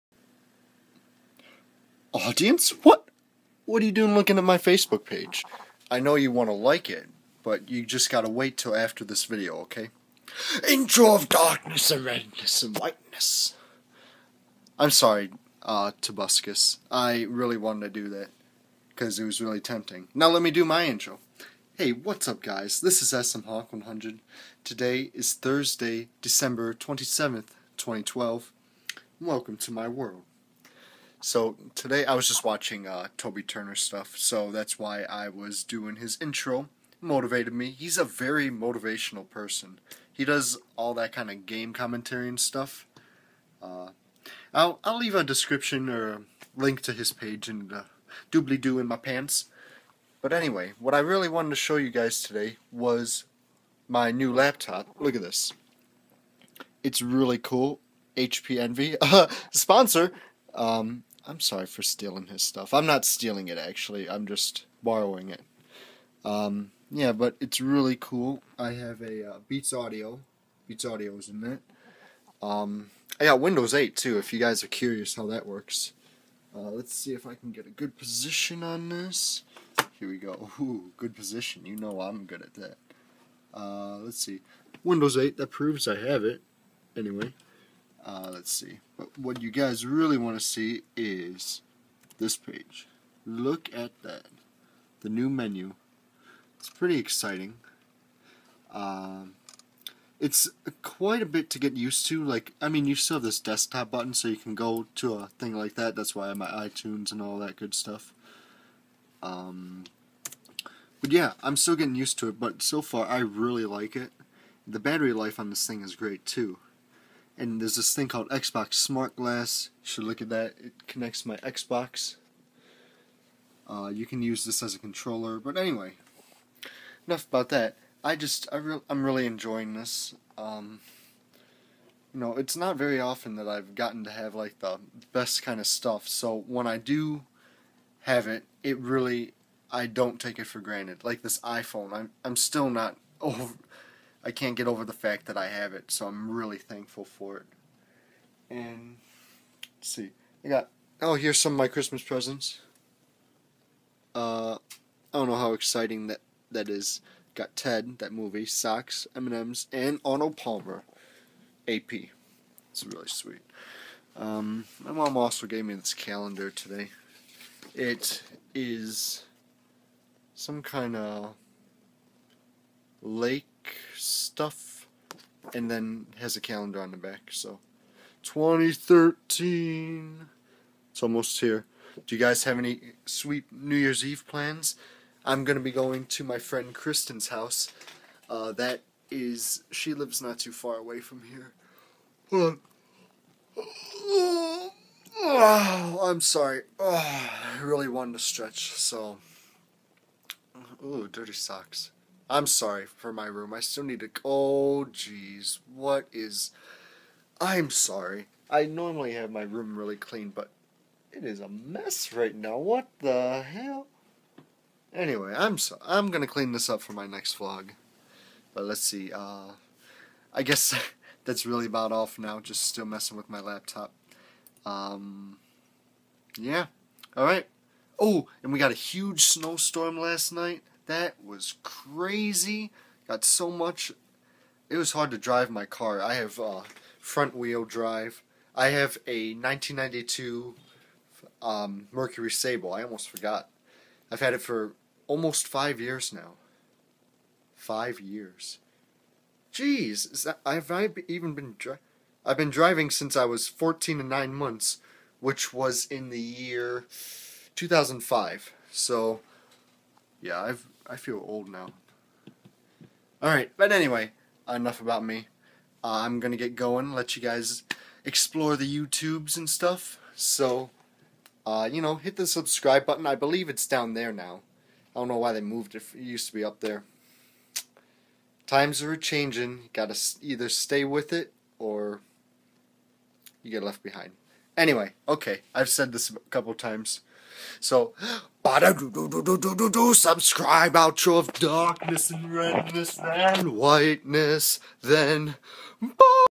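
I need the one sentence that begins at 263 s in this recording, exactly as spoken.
All right, but anyway, enough about me.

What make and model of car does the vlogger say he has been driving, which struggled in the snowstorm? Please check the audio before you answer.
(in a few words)
Mercury Sable.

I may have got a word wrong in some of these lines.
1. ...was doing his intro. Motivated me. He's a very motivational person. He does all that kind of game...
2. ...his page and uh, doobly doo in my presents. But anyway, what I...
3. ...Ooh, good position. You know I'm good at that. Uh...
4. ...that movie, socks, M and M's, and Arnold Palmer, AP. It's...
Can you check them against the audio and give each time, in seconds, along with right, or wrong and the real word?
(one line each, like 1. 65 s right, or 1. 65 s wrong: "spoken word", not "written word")
1. 35 s right
2. 46 s wrong: "pants", not "presents"
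3. 80 s right
4. 157 s right.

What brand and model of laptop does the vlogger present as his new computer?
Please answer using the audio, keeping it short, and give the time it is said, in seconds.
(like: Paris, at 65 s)
HP Envy, at 58 s.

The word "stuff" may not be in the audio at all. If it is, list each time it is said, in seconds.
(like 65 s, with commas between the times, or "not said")
33 s, 42 s, 62 s, 107 s, 135 s, 173 s, 269 s.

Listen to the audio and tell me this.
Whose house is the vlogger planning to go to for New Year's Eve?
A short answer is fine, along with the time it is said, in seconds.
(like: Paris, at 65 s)
Kristen, at 186 s.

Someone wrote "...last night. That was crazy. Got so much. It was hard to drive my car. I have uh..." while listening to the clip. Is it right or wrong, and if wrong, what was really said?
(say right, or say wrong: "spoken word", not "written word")
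right.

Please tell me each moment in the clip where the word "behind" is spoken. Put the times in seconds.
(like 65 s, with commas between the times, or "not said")
283 s.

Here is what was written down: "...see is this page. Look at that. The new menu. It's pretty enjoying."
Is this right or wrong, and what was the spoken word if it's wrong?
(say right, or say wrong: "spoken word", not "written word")
wrong: "exciting", not "enjoying".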